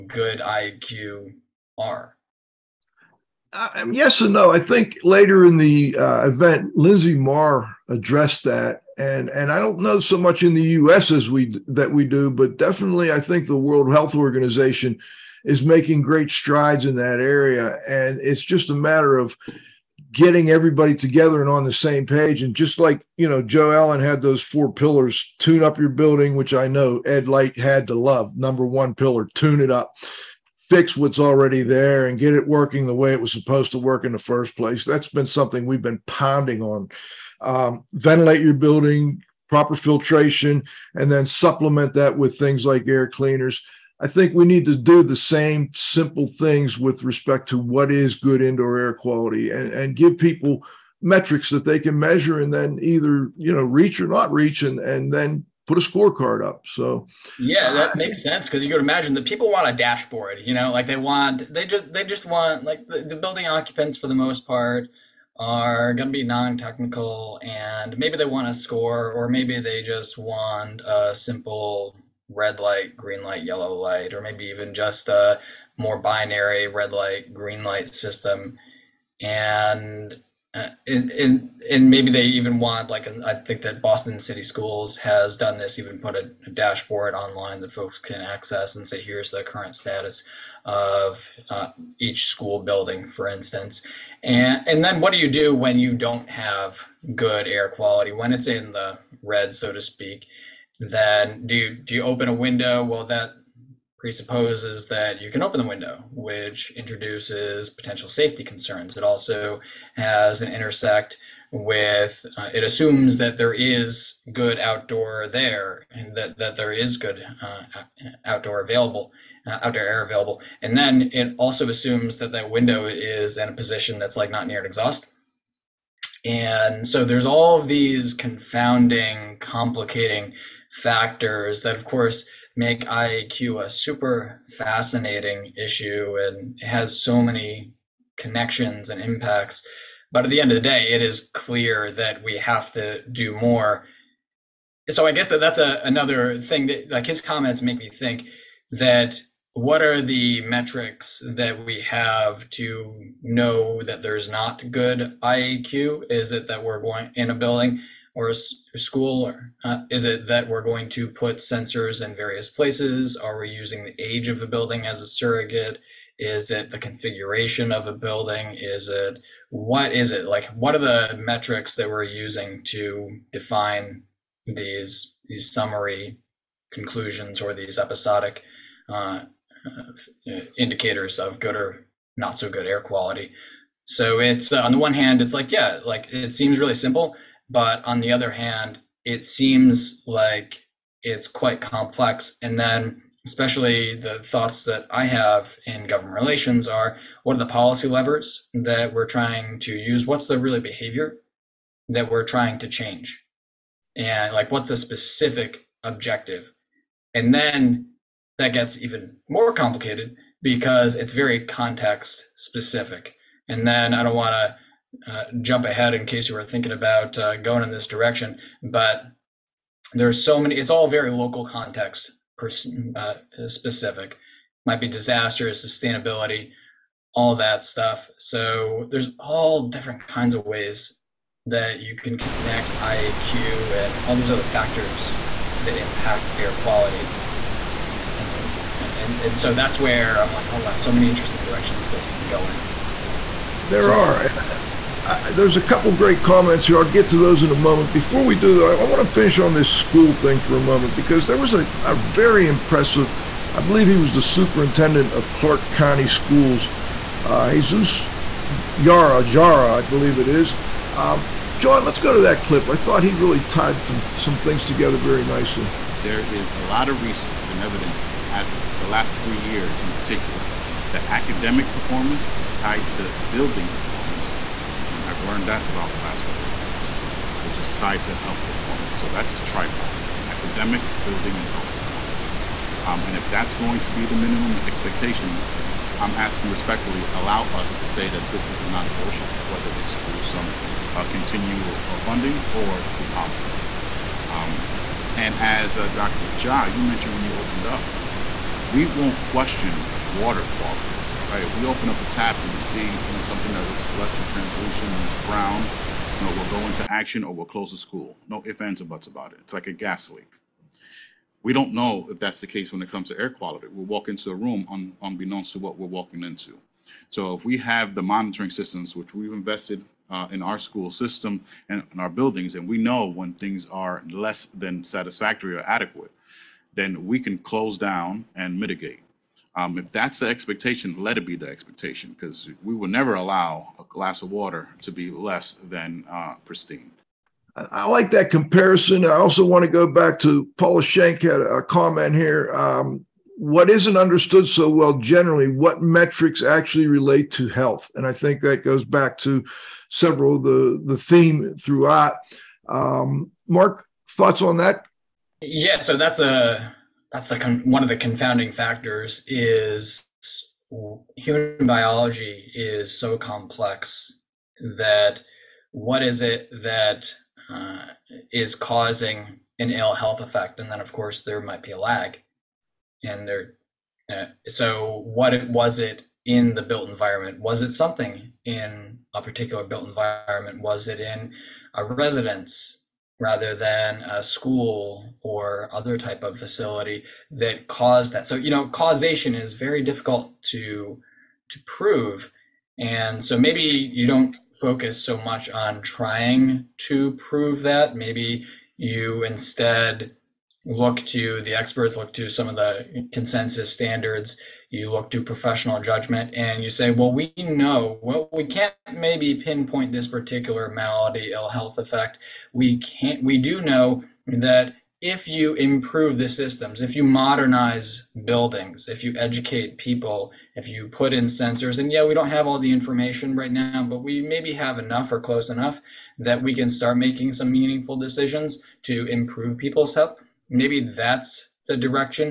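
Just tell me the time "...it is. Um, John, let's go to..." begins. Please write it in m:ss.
4:20.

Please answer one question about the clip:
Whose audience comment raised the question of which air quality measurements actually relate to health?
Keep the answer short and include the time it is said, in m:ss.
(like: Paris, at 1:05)
Paula Shank, at 5:40.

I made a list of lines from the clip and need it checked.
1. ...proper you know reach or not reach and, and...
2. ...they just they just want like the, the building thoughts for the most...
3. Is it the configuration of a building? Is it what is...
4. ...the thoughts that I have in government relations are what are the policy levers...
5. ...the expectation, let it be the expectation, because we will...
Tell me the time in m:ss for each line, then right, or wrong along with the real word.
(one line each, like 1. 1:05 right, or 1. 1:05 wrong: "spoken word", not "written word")
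1. 0:52 wrong: "either", not "proper"
2. 1:01 wrong: "occupants", not "thoughts"
3. 2:46 right
4. 3:13 right
5. 5:30 right.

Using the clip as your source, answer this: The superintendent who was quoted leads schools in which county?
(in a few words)
Clark County.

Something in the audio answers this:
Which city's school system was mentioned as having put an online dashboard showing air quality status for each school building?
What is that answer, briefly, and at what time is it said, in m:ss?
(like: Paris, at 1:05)
Boston, at 1:23.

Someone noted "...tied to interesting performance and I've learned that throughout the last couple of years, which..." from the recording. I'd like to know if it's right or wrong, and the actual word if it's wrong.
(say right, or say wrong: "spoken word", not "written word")
wrong: "building", not "interesting".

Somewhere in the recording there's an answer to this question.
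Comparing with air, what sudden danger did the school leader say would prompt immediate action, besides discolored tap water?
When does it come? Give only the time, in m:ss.
5:09.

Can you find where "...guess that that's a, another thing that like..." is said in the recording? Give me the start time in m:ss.
2:25.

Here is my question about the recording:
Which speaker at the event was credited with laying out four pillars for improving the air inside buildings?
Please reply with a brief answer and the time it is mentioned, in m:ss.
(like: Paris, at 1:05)
Joe Allen, at 0:23.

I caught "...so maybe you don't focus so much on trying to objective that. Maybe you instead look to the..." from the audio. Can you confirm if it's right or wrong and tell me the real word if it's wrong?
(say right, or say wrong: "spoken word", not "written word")
wrong: "prove", not "objective".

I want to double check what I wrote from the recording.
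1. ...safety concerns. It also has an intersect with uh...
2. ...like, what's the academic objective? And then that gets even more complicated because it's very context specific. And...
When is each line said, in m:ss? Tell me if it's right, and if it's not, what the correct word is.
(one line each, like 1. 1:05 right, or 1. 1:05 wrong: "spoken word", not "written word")
1. 1:48 right
2. 3:24 wrong: "specific", not "academic".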